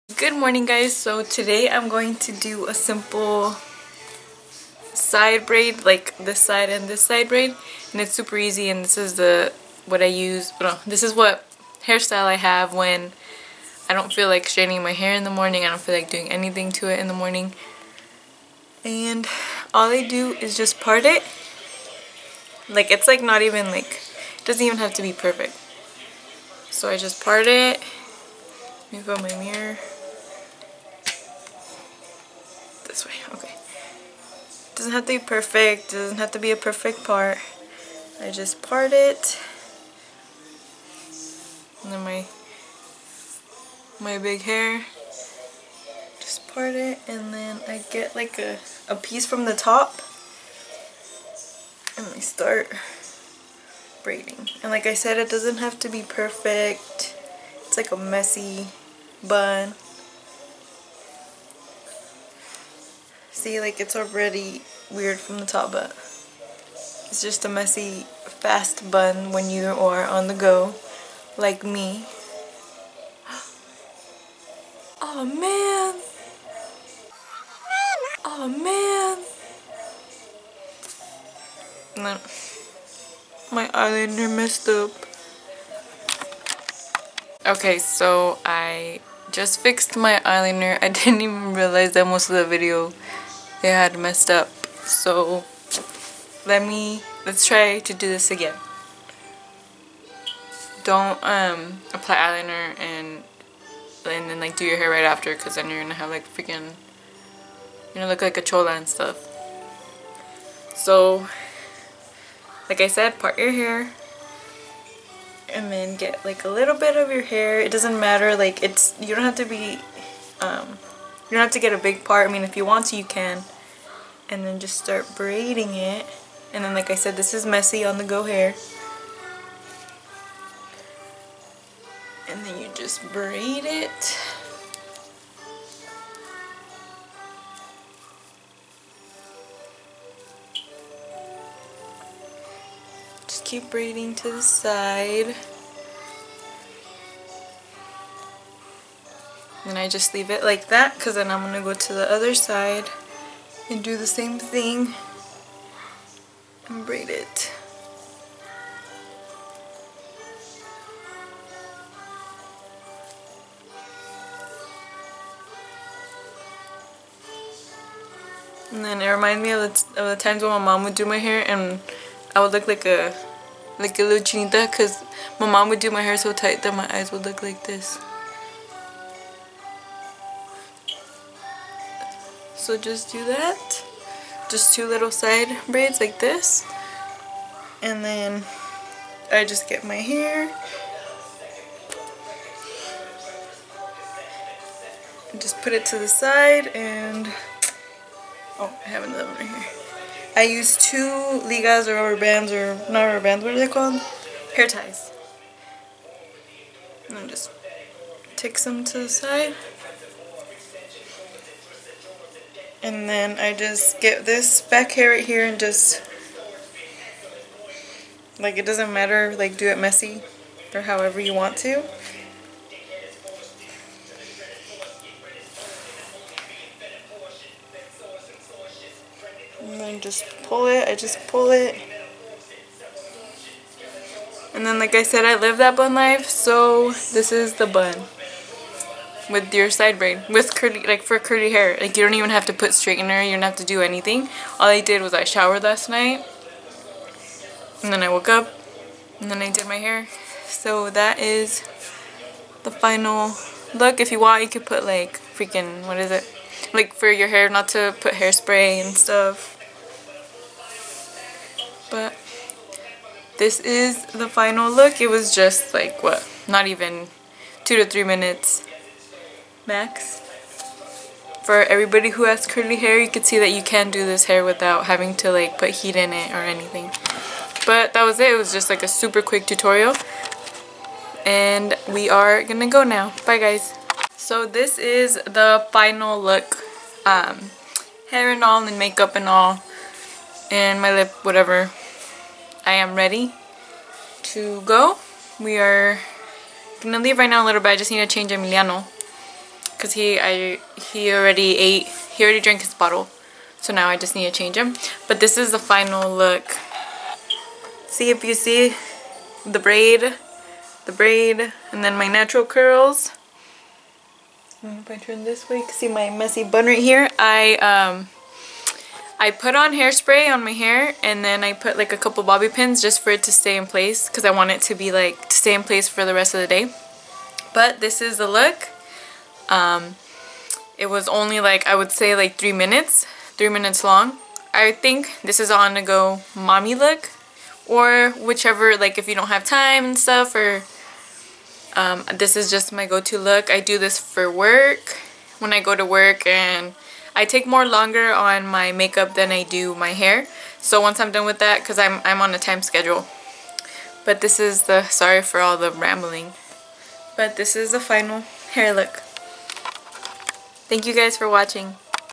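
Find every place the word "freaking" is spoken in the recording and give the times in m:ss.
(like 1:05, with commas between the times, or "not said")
1:46, 4:15.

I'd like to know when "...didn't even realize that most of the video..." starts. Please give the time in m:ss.
1:30.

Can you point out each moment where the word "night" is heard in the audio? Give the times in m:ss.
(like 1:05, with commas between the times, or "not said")
4:05.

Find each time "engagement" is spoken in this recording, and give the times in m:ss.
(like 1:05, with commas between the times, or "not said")
not said.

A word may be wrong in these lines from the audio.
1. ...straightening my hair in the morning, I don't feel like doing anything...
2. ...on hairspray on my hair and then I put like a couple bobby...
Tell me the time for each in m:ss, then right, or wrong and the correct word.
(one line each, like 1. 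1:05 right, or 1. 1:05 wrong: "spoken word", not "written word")
1. 0:14 right
2. 5:19 right.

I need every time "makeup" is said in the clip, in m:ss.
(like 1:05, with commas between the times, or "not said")
4:48, 5:48.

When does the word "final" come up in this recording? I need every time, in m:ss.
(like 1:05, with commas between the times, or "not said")
4:12, 4:24, 4:45, 5:05, 5:57.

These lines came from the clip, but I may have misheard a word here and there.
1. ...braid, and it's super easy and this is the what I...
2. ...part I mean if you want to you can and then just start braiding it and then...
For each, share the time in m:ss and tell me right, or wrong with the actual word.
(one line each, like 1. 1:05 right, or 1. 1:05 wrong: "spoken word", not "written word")
1. 0:07 right
2. 2:02 right.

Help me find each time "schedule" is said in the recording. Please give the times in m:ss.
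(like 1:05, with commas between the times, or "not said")
5:52.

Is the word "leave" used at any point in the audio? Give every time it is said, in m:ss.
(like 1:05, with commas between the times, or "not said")
2:30, 4:56.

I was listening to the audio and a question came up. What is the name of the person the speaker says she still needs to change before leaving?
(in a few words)
Emiliano.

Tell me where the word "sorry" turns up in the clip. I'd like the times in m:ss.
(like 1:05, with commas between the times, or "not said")
5:54.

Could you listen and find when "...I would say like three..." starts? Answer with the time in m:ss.
5:31.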